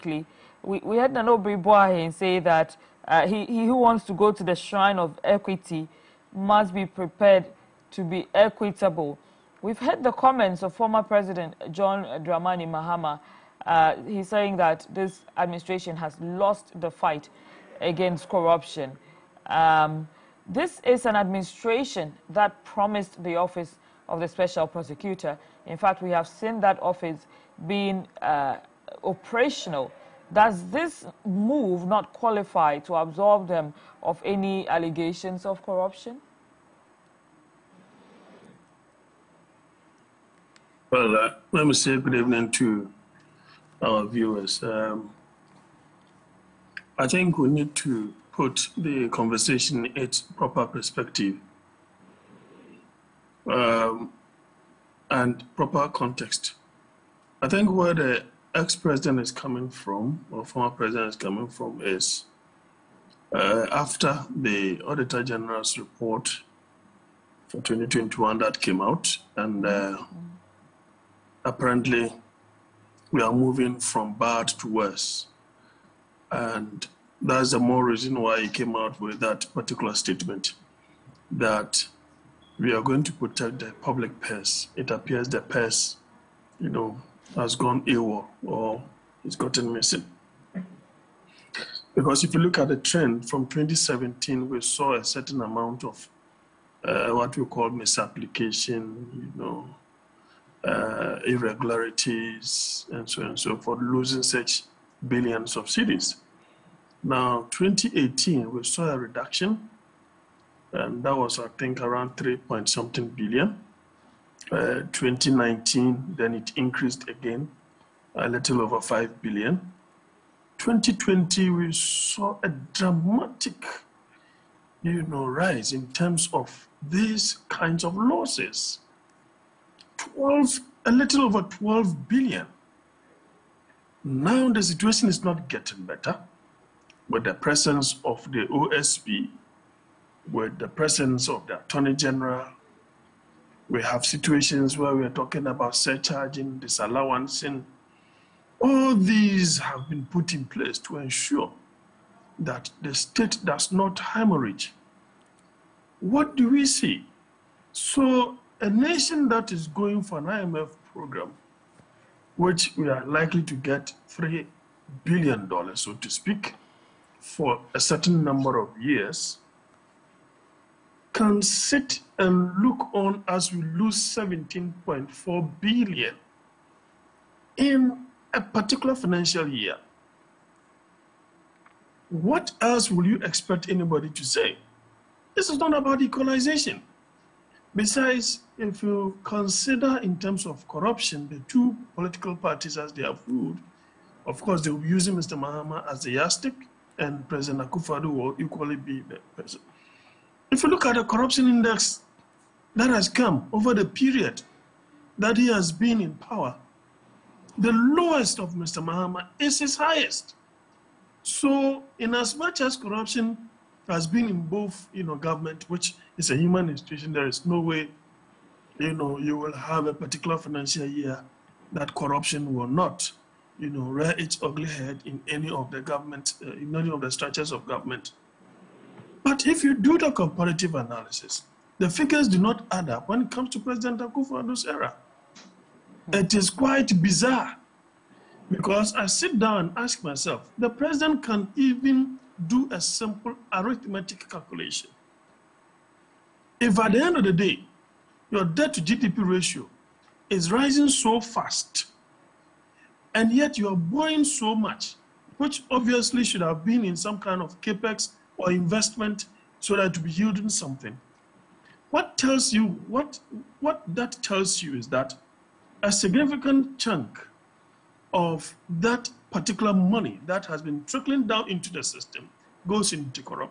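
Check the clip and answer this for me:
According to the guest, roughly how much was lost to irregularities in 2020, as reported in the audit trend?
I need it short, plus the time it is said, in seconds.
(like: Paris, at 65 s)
a little over 12 billion, at 129 s.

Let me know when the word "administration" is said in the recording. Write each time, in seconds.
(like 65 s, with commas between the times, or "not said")
15 s, 21 s.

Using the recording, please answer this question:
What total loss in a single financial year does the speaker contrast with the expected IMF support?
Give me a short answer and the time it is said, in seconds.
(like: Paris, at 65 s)
17.4 billion, at 173 s.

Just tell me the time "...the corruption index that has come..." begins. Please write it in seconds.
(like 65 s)
200 s.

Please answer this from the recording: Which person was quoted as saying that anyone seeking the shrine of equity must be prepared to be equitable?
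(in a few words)
Nana Obiri Boahen.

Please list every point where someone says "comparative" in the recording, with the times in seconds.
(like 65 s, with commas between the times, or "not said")
230 s.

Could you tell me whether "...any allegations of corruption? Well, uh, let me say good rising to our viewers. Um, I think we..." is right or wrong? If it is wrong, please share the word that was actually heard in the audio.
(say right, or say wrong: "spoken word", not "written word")
wrong: "evening", not "rising".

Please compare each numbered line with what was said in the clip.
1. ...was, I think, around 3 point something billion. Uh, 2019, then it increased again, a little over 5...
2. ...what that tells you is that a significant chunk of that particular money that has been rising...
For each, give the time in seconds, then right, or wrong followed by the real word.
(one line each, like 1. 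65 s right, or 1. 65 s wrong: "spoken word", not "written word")
1. 111 s right
2. 263 s wrong: "trickling", not "rising".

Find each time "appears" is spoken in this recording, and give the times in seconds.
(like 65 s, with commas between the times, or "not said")
84 s.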